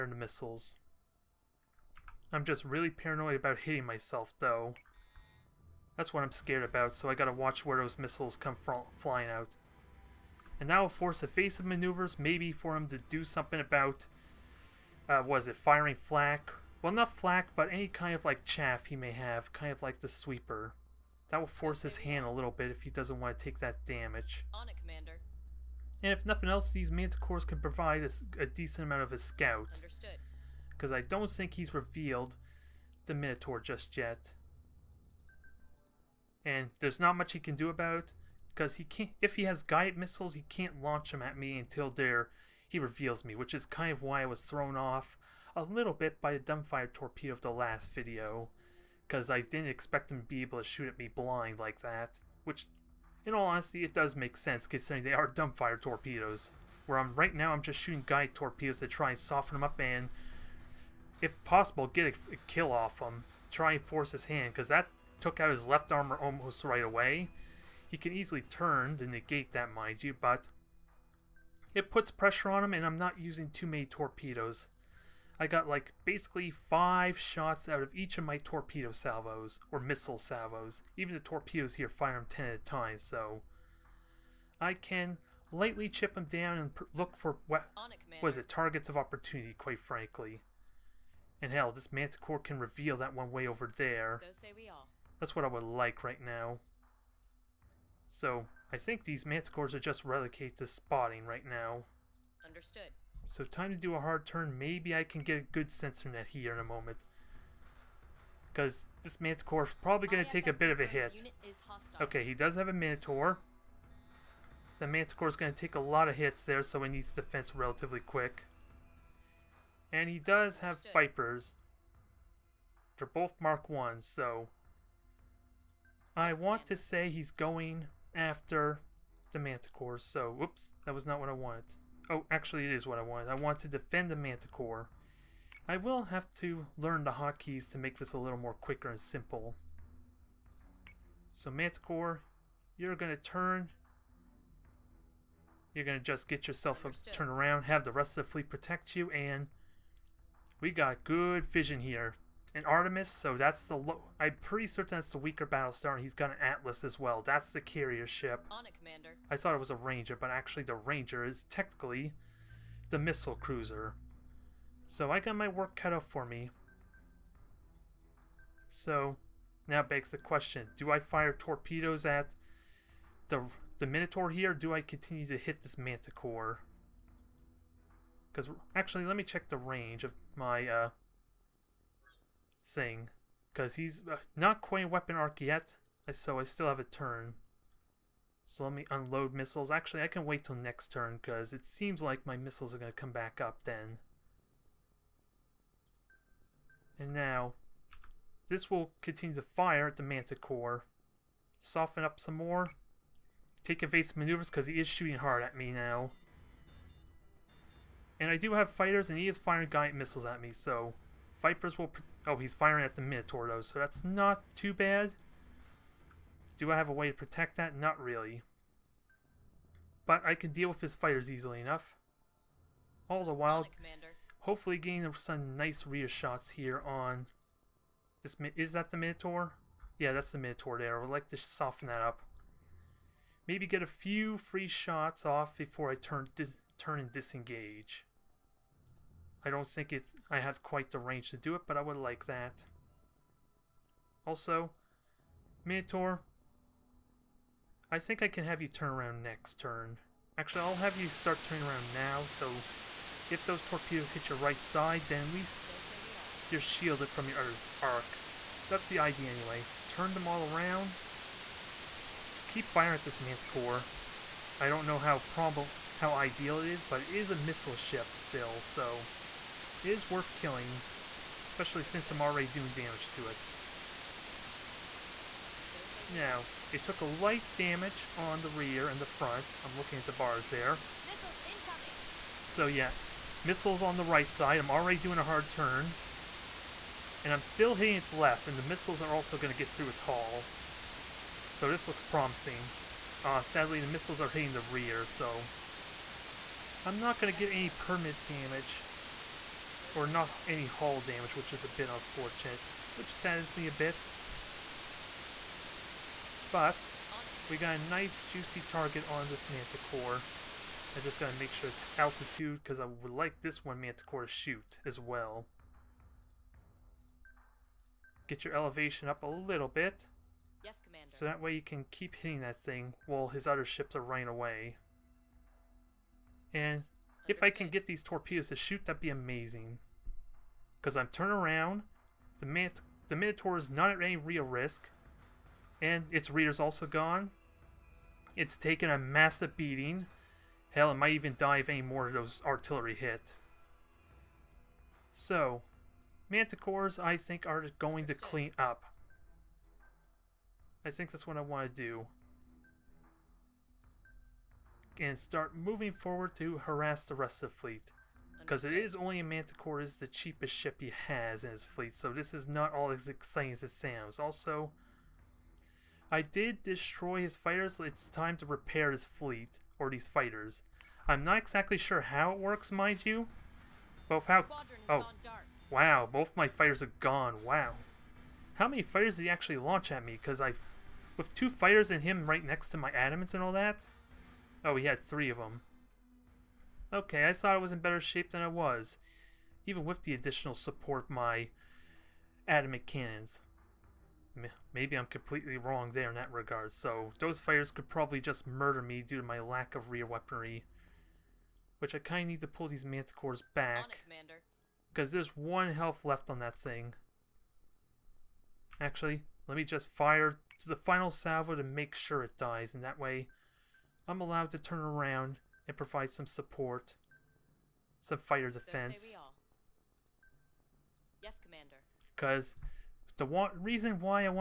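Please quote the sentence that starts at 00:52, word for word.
Which, in all honesty, it does make sense considering they are dumbfire torpedoes.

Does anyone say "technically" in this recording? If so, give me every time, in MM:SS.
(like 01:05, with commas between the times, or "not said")
02:41.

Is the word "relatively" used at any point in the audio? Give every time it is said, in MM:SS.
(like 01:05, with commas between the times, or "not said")
01:57.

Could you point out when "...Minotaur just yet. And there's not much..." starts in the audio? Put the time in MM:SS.
00:33.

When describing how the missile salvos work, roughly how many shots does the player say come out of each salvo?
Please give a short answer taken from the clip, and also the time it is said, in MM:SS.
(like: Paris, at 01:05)
5, at 01:16.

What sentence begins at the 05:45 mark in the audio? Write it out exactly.
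So, Manticores, I think, are going to clean up.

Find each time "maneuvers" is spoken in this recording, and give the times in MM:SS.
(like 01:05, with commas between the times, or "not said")
00:11, 03:24.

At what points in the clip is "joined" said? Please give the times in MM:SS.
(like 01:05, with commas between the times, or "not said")
not said.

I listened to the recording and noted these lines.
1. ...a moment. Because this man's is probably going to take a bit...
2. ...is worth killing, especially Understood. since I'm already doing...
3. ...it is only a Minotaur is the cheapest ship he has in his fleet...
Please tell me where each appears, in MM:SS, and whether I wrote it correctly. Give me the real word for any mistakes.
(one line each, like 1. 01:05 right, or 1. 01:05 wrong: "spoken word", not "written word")
1. 01:46 right
2. 04:29 right
3. 05:58 wrong: "Manticore", not "Minotaur".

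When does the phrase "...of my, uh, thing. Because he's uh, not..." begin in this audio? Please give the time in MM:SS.
03:00.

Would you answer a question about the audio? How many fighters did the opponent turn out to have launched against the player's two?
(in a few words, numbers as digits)
3.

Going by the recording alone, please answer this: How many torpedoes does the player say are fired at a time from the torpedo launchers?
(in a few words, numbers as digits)
10.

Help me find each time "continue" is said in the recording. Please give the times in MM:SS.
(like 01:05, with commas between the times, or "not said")
02:54, 03:19.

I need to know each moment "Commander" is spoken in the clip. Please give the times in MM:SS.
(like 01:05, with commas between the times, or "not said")
00:24, 02:38, 03:43, 05:20, 07:01.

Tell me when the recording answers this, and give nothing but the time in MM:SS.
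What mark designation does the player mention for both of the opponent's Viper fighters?
02:03.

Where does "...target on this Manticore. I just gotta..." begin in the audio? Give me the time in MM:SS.
05:08.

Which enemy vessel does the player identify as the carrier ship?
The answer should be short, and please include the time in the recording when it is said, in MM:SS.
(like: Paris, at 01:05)
Atlas, at 02:36.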